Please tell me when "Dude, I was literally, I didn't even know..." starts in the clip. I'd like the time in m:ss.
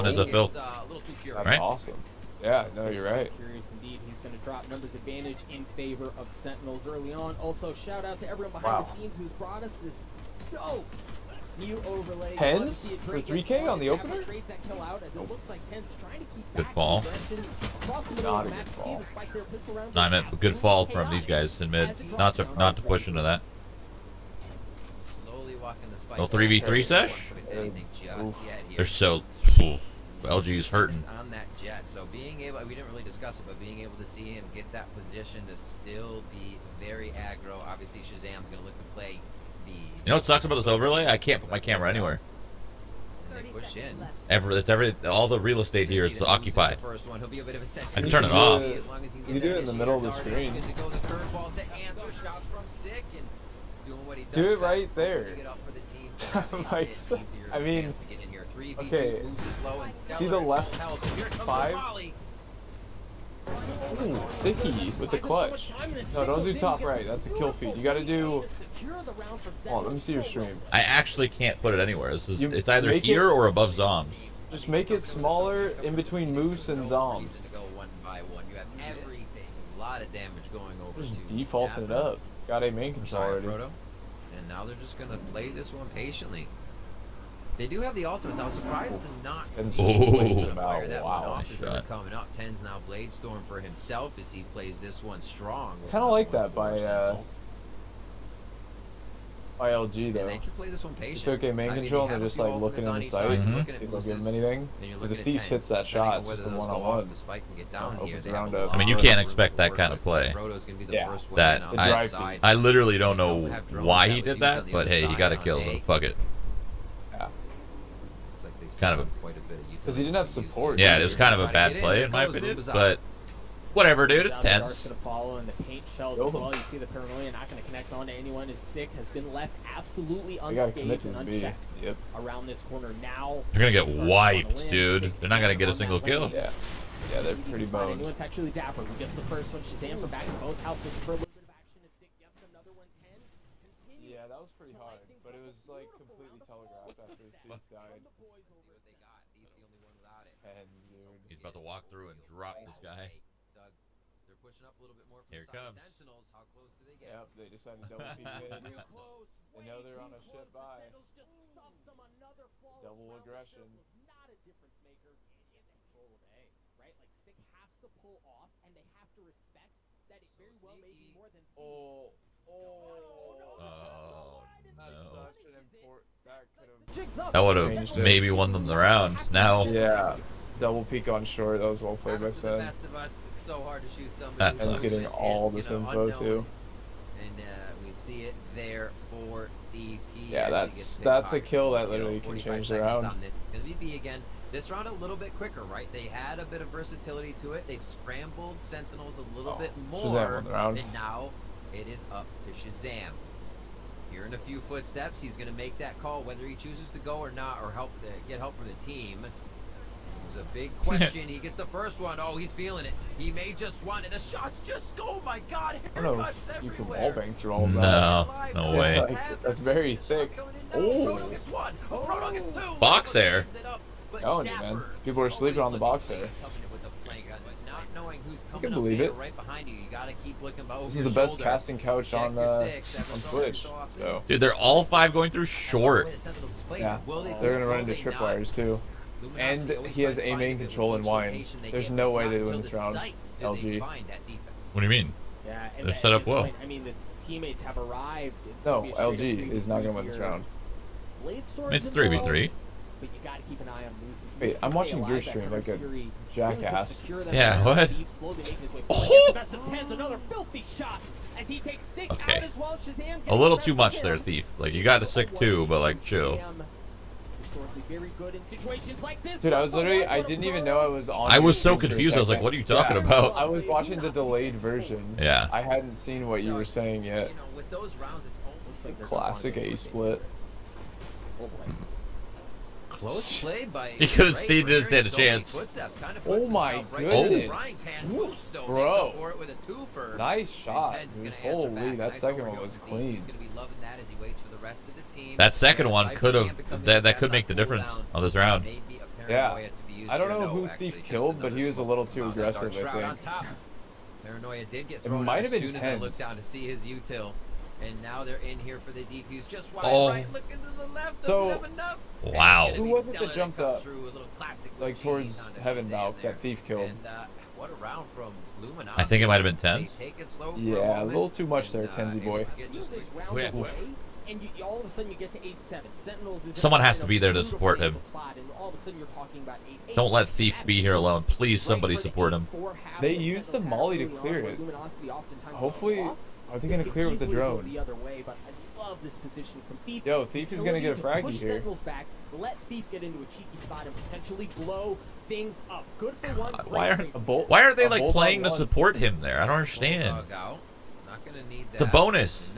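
4:29.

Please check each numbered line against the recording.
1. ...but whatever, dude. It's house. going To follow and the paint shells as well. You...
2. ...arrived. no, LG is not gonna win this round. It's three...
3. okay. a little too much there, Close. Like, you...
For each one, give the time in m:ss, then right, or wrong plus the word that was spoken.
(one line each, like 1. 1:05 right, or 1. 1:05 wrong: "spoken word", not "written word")
1. 2:02 wrong: "tense", not "house"
2. 4:07 right
3. 4:22 wrong: "Thief", not "Close".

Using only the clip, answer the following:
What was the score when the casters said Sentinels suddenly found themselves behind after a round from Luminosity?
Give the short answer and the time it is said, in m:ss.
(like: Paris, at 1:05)
8-7, at 5:25.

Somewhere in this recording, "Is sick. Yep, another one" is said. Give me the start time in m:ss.
2:21.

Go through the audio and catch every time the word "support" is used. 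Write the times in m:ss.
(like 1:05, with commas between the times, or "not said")
2:00, 5:27, 5:31, 5:48.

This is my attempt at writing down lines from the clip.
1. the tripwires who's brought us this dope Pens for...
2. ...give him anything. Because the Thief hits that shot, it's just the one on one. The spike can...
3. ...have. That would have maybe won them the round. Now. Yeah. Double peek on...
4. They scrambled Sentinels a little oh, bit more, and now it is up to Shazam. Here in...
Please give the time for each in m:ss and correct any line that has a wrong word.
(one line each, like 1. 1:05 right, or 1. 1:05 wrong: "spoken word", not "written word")
1. 0:08 wrong: "scenes", not "tripwires"
2. 1:44 right
3. 2:56 right
4. 3:17 right.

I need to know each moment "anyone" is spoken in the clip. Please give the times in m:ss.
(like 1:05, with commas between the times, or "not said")
2:08, 2:17.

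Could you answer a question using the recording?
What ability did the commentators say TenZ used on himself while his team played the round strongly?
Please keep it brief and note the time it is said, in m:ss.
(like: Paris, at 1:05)
Blade Storm, at 1:32.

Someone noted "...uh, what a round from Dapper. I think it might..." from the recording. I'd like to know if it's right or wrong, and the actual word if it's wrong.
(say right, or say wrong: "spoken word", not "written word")
wrong: "Luminosity", not "Dapper".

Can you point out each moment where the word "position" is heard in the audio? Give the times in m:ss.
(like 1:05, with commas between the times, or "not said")
0:34, 5:39.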